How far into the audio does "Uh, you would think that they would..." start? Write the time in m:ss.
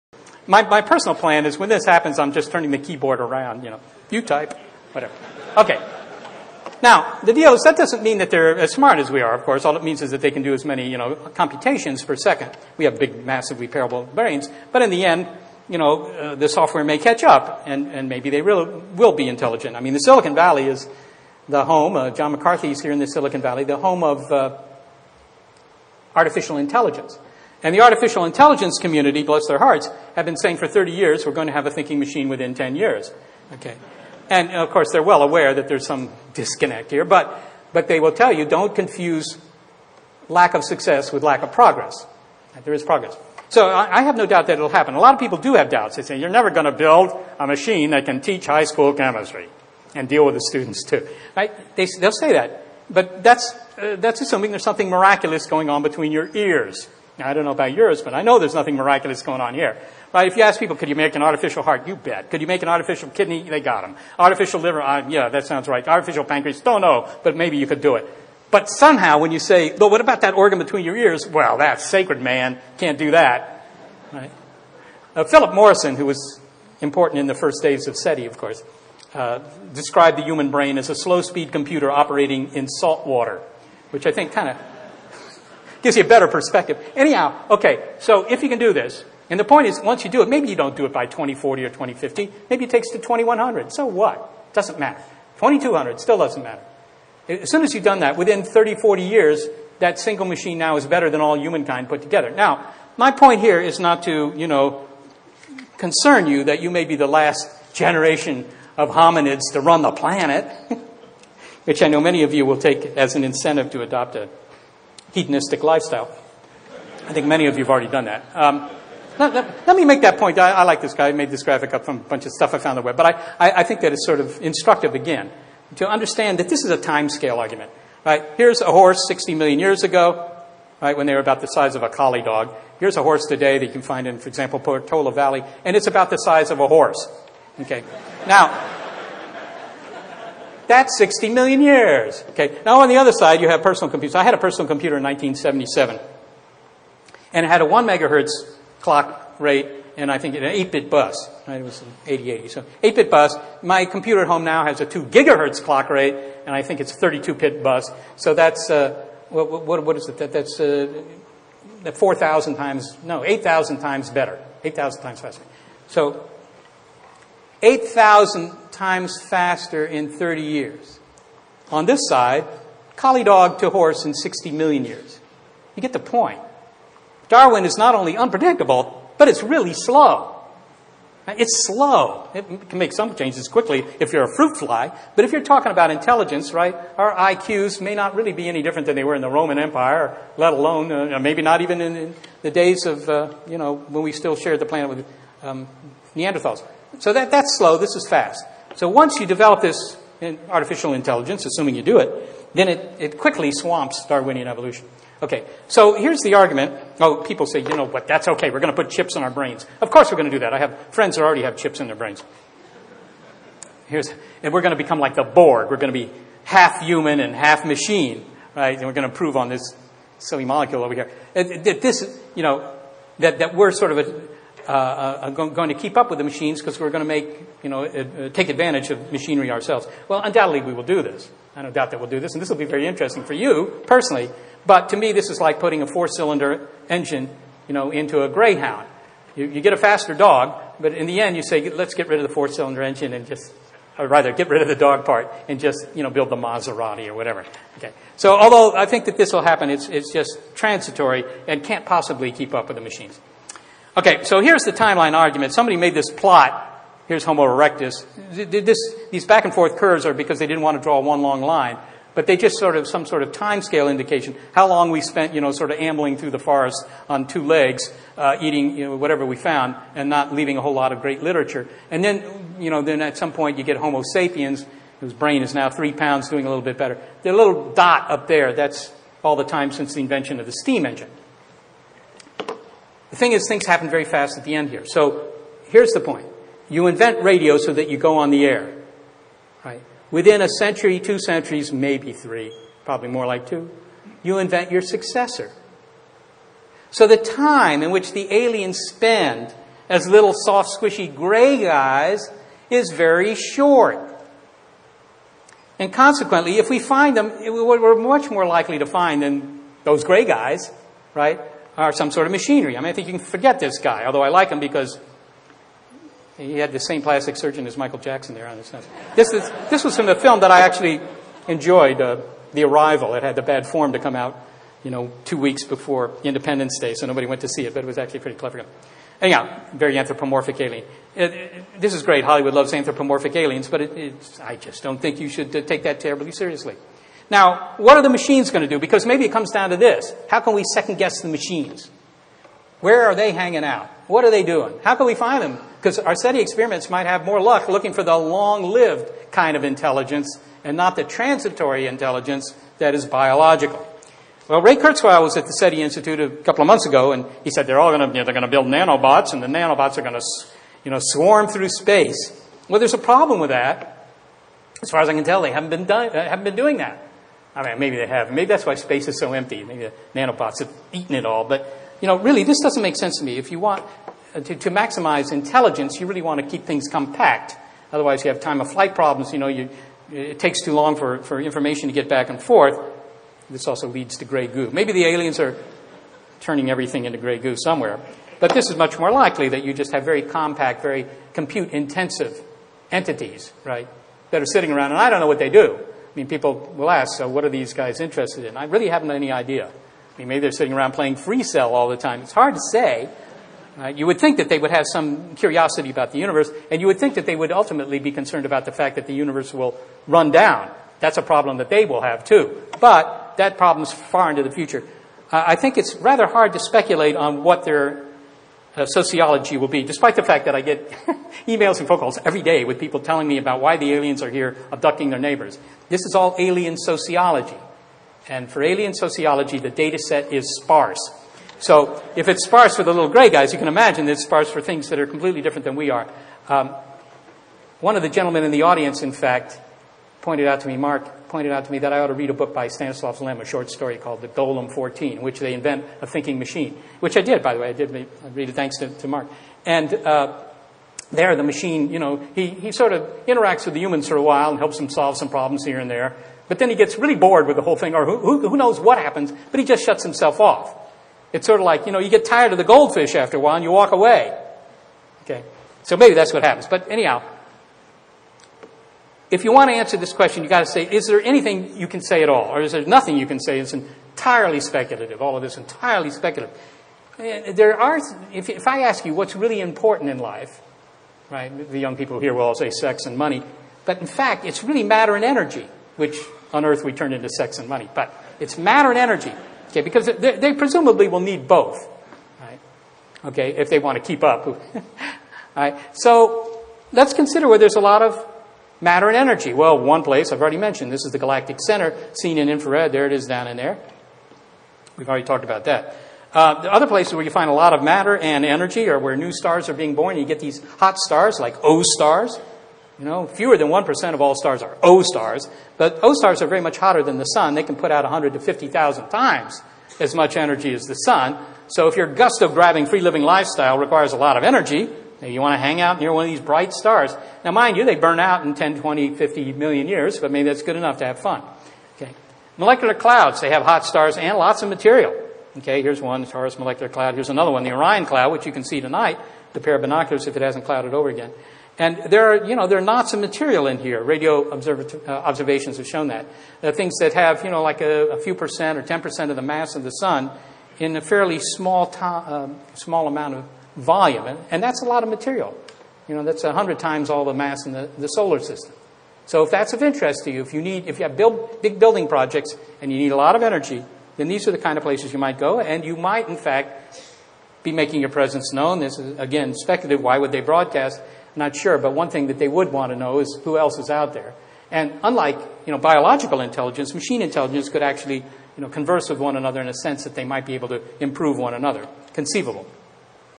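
6:43.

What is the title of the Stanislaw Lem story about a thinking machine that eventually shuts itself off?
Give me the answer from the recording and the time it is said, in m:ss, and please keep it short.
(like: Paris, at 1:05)
The Golem 14, at 7:24.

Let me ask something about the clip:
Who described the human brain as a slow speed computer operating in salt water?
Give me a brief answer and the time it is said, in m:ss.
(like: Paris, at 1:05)
Philip Morrison, at 1:15.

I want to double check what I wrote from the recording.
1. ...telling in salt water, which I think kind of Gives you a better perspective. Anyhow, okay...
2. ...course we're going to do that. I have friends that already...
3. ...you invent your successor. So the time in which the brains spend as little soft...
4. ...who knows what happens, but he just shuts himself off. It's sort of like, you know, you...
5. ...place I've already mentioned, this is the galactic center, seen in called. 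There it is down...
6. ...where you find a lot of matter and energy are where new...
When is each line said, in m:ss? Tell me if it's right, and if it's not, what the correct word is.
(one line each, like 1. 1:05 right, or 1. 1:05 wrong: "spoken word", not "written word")
1. 1:21 wrong: "operating", not "telling"
2. 3:29 right
3. 4:54 wrong: "aliens", not "brains"
4. 7:38 right
5. 8:20 wrong: "infrared", not "called"
6. 8:27 right.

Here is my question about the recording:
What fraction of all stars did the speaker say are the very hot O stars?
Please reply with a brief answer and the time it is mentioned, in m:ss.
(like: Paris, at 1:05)
fewer than 1%, at 8:33.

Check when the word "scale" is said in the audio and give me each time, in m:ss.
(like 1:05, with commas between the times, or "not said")
2:07, 4:23.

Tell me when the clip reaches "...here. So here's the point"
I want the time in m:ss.
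4:44.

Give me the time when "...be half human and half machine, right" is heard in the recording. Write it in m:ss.
3:35.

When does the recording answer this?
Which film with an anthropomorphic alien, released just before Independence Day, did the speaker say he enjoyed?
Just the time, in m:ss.
5:22.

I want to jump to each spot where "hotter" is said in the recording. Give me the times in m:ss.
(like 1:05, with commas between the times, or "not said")
8:36.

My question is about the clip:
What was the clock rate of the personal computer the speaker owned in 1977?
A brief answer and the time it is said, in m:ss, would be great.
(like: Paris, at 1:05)
1 megahertz, at 2:27.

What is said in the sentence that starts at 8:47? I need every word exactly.
Now, mind you, they burn out in 10, 20, 50 million years, but maybe that's good enough to have fun.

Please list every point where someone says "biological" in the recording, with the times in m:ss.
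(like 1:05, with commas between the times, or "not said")
5:53, 9:35.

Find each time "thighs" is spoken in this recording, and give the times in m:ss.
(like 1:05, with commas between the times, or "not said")
not said.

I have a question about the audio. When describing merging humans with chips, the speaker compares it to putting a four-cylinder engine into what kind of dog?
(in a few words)
Greyhound.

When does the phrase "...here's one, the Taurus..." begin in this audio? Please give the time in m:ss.
8:55.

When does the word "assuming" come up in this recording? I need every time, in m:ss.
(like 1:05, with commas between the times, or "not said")
0:54, 3:21.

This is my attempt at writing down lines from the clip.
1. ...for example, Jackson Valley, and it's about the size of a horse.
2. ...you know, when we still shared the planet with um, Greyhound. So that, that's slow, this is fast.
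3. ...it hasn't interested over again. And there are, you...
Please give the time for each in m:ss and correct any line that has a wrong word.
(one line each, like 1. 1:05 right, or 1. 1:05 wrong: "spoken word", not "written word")
1. 2:14 wrong: "Portola", not "Jackson"
2. 3:13 wrong: "Neanderthals", not "Greyhound"
3. 9:00 wrong: "clouded", not "interested".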